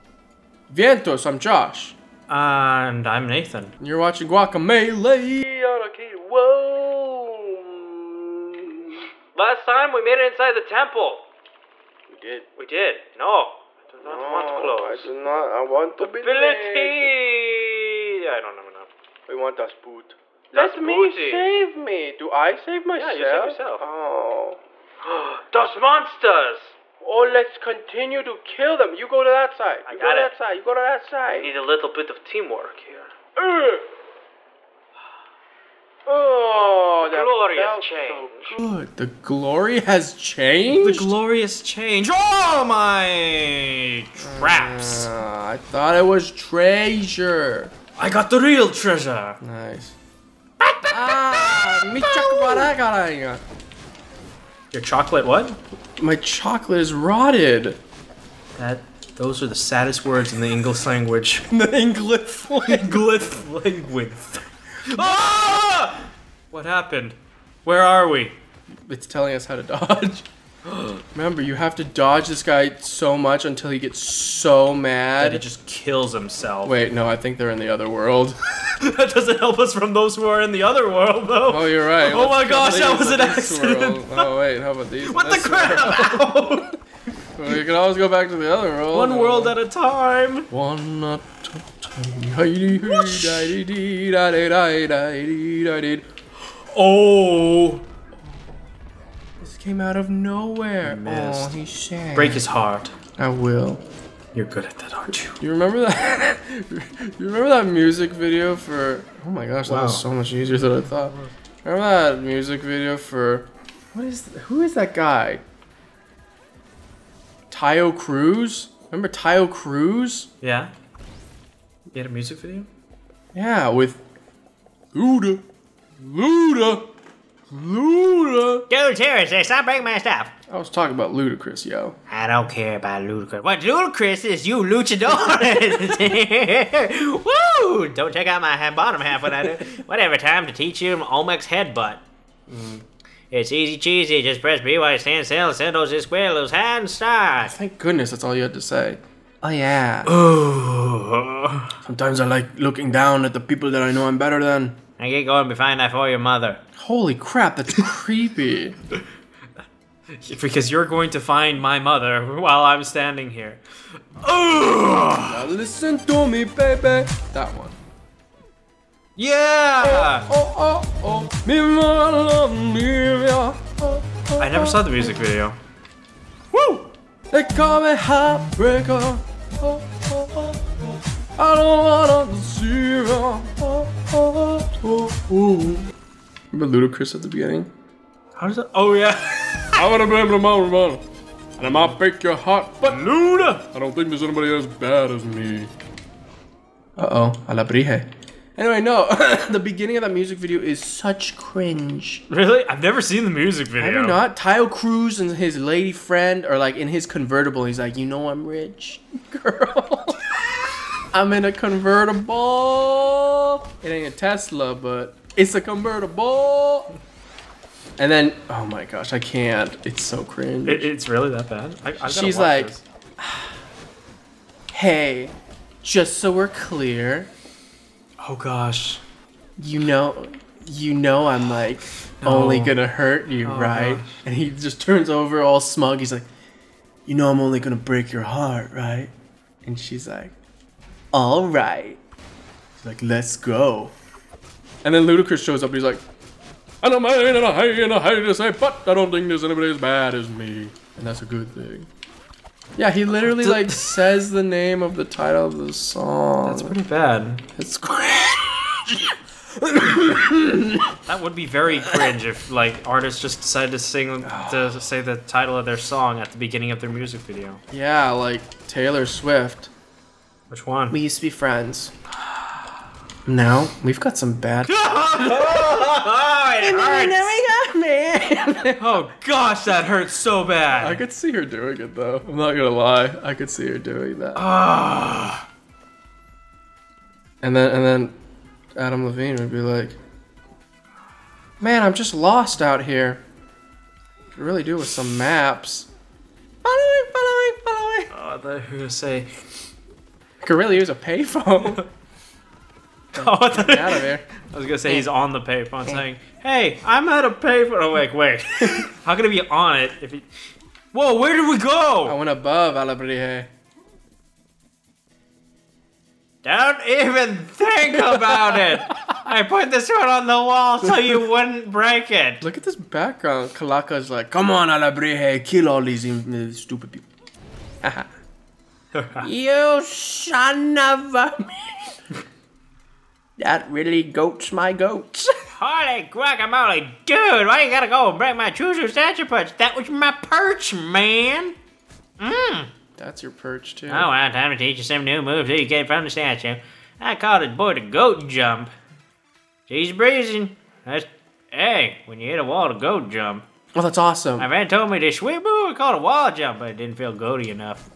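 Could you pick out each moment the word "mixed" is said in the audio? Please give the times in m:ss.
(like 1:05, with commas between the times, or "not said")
not said.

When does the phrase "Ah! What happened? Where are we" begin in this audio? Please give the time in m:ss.
1:04.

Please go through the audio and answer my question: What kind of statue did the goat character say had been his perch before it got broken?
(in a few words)
Choozo statue.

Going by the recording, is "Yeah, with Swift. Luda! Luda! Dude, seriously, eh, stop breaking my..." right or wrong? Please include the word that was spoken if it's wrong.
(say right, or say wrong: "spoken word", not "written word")
wrong: "Uda", not "Swift".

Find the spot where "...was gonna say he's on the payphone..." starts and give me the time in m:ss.
5:04.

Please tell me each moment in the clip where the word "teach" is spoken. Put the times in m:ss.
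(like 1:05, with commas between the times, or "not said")
2:20, 5:44.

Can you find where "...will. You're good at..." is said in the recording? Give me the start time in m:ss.
1:43.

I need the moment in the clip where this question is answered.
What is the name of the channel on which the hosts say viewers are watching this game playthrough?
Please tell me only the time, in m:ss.
0:05.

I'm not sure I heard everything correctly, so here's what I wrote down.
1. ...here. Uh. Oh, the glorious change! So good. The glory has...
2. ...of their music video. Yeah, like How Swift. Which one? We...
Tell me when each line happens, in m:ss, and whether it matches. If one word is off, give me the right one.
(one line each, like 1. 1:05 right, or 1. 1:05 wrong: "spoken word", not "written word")
1. 0:32 right
2. 4:26 wrong: "Taylor", not "How".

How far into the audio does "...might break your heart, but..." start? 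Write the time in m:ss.
3:11.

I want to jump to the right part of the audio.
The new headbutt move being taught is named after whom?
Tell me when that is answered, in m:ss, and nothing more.
2:21.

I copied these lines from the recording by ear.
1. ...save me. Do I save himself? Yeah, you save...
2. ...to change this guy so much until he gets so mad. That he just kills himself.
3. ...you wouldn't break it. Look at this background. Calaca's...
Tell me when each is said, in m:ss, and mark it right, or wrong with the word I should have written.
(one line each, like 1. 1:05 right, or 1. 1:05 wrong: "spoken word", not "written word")
1. 0:21 wrong: "myself", not "himself"
2. 1:11 wrong: "dodge", not "change"
3. 5:20 right.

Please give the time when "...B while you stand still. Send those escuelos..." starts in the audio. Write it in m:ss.
2:24.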